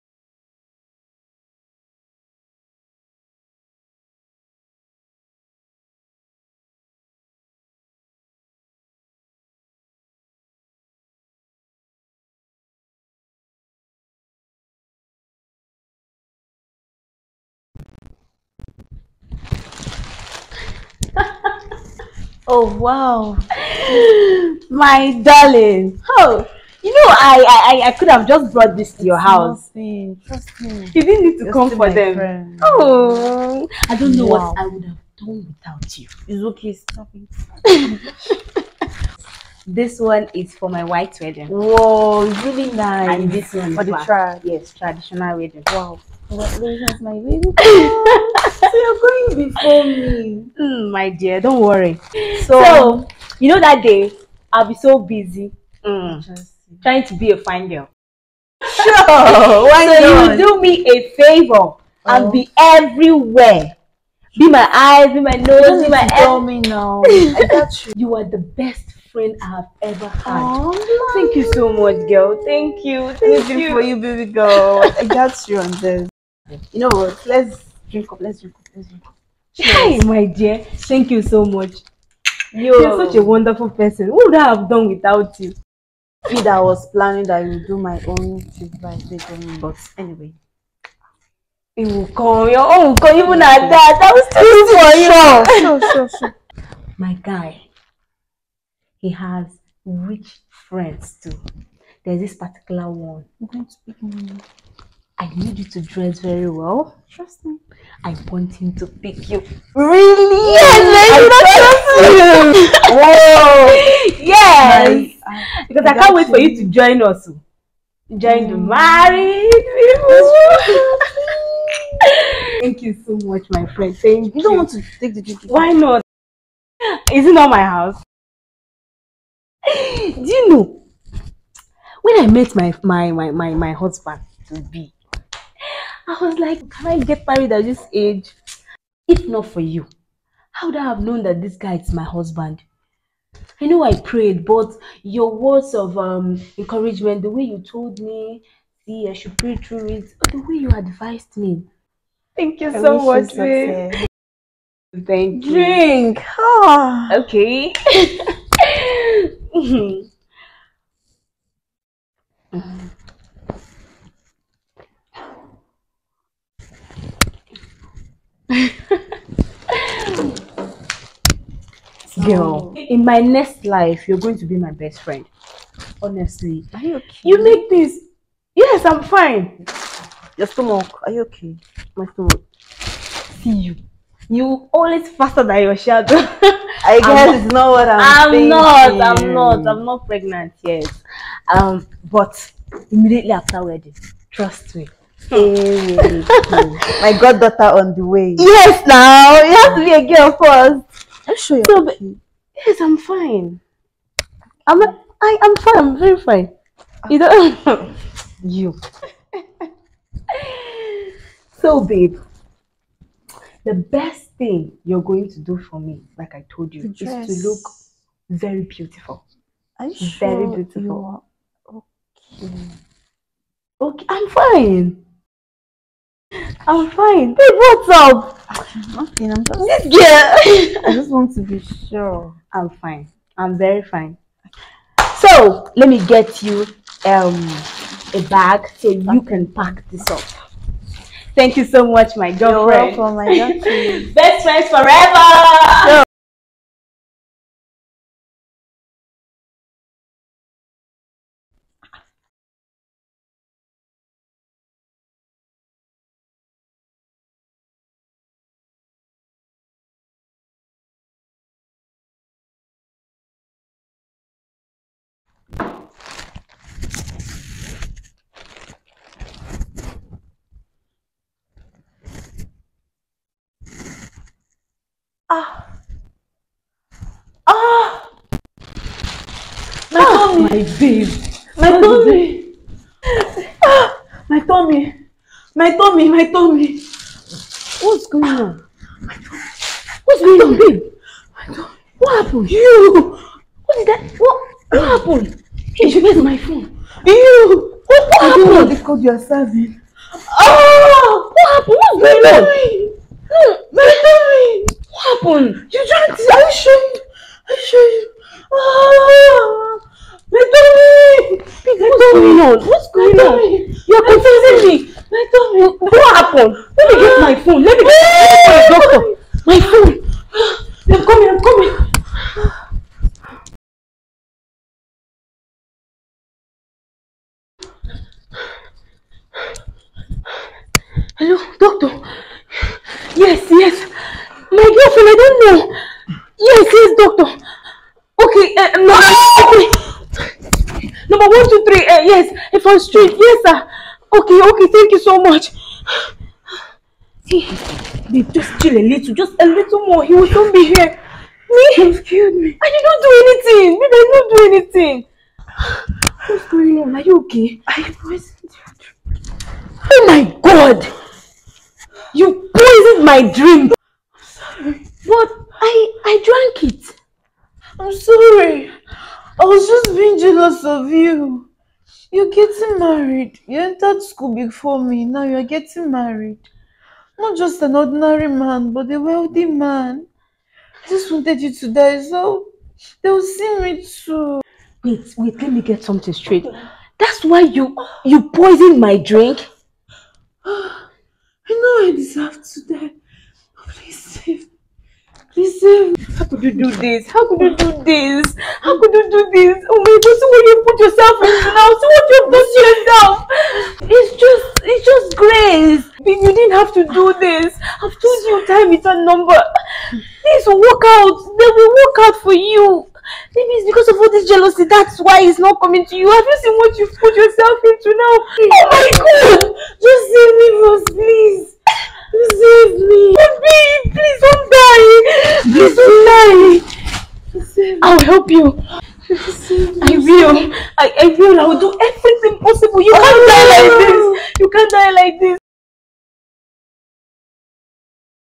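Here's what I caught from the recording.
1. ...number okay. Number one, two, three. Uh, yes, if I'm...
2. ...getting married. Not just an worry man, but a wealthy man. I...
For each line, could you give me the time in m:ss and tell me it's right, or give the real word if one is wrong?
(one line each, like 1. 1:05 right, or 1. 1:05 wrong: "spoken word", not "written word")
1. 5:38 right
2. 6:15 wrong: "ordinary", not "worry".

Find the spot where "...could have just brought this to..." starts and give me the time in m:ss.
0:27.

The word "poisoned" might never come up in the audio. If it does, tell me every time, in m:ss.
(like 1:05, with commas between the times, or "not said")
5:58, 6:02, 6:28.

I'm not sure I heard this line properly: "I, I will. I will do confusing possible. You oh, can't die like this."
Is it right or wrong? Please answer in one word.
wrong.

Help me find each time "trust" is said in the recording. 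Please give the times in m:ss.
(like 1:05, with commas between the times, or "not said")
0:30, 1:47, 1:52, 3:14.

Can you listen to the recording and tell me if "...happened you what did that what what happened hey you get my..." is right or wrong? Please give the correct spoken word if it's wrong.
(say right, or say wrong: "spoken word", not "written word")
right.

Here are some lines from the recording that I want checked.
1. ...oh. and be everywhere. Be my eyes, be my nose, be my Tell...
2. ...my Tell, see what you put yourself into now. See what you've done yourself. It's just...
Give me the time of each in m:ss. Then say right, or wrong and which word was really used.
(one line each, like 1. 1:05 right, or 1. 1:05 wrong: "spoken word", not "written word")
1. 1:01 right
2. 6:39 wrong: "God", not "Tell".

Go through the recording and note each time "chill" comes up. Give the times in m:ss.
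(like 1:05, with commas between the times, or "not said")
5:48.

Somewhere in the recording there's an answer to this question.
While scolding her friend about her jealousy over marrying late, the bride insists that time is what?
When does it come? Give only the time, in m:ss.
6:48.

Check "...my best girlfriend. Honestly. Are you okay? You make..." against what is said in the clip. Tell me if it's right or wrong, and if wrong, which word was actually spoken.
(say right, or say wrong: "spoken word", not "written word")
wrong: "friend", not "girlfriend".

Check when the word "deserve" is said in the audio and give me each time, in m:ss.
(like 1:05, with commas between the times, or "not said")
6:31.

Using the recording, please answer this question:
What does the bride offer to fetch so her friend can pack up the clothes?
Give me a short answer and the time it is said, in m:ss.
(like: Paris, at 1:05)
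A bag, at 3:58.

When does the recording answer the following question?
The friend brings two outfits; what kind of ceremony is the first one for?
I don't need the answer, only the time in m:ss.
0:40.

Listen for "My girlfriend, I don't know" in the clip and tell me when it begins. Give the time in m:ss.
5:34.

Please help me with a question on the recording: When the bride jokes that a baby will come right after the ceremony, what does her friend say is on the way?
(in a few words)
My goddaughter.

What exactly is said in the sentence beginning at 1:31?
It will come, your own will come, even at that.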